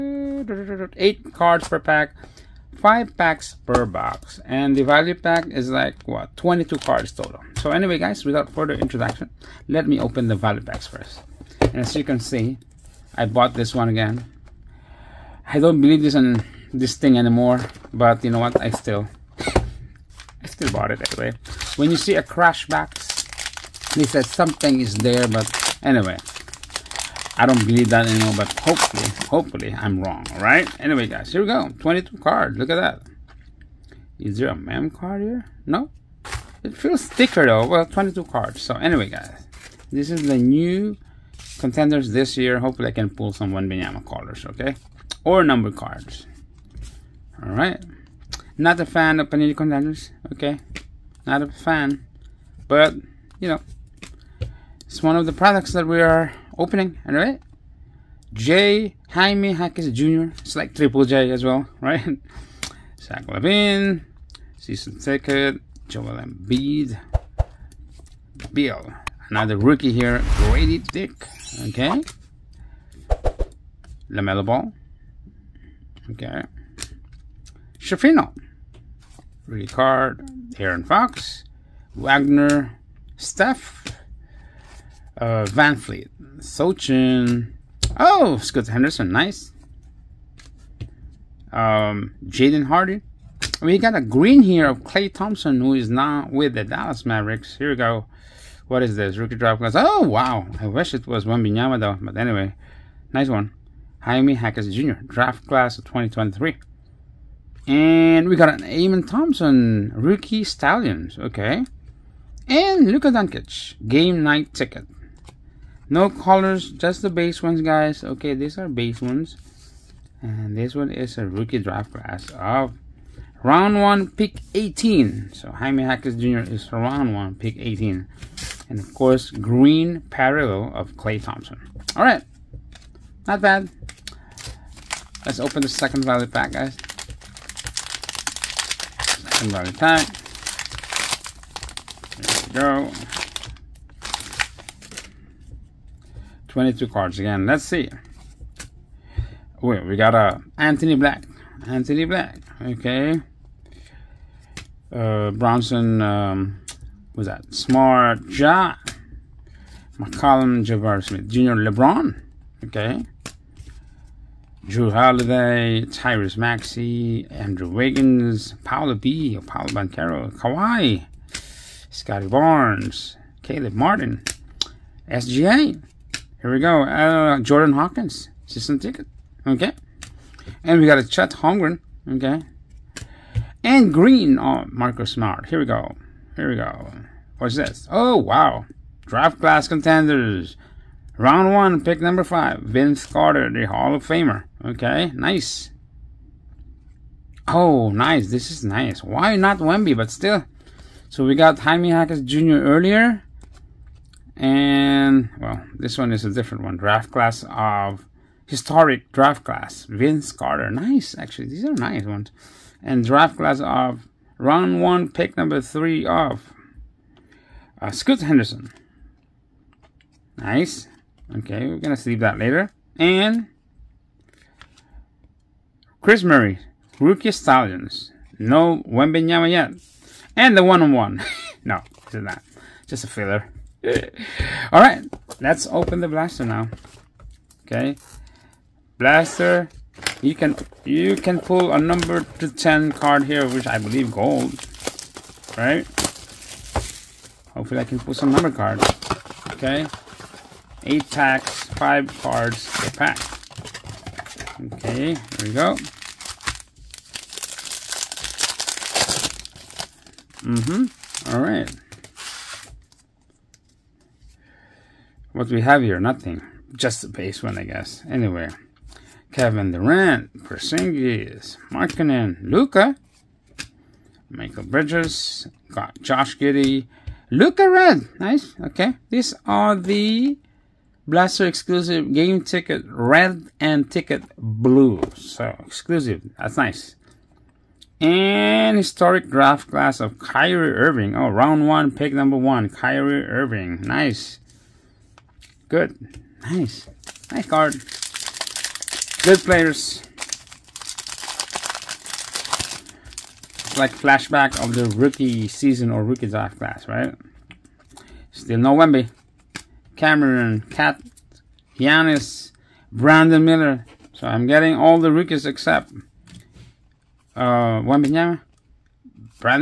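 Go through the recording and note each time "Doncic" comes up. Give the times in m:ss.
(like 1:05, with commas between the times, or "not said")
1:53.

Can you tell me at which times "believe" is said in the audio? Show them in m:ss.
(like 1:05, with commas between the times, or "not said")
0:15, 0:27, 4:03.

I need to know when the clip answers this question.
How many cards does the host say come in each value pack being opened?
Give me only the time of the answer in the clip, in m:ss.
0:06.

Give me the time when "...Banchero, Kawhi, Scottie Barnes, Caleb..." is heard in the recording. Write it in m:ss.
2:49.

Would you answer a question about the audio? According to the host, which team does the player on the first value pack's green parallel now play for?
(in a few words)
Dallas Mavericks.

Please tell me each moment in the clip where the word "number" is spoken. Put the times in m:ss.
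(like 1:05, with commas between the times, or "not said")
0:45, 3:12, 3:35, 4:01, 4:08, 4:52.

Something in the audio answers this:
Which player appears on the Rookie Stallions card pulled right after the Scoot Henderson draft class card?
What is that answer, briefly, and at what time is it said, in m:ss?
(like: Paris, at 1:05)
Kris Murray, at 3:46.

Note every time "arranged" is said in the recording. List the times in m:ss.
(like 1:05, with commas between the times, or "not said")
not said.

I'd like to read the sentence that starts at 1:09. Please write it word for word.
Another rookie here, Gradey Dick, okay?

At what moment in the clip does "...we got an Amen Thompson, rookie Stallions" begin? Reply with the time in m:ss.
1:48.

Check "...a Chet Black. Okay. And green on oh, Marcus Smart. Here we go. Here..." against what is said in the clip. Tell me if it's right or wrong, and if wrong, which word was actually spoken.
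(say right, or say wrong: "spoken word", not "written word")
wrong: "Holmgren", not "Black".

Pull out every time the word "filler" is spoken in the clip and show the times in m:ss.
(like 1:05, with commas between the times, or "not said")
3:53.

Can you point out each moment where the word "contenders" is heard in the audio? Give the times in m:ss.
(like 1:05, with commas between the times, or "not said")
0:41, 0:49, 3:09.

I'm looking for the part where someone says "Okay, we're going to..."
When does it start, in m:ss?
3:41.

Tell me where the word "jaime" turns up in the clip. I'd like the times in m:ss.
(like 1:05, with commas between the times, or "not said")
0:59, 1:44, 2:05, 3:21.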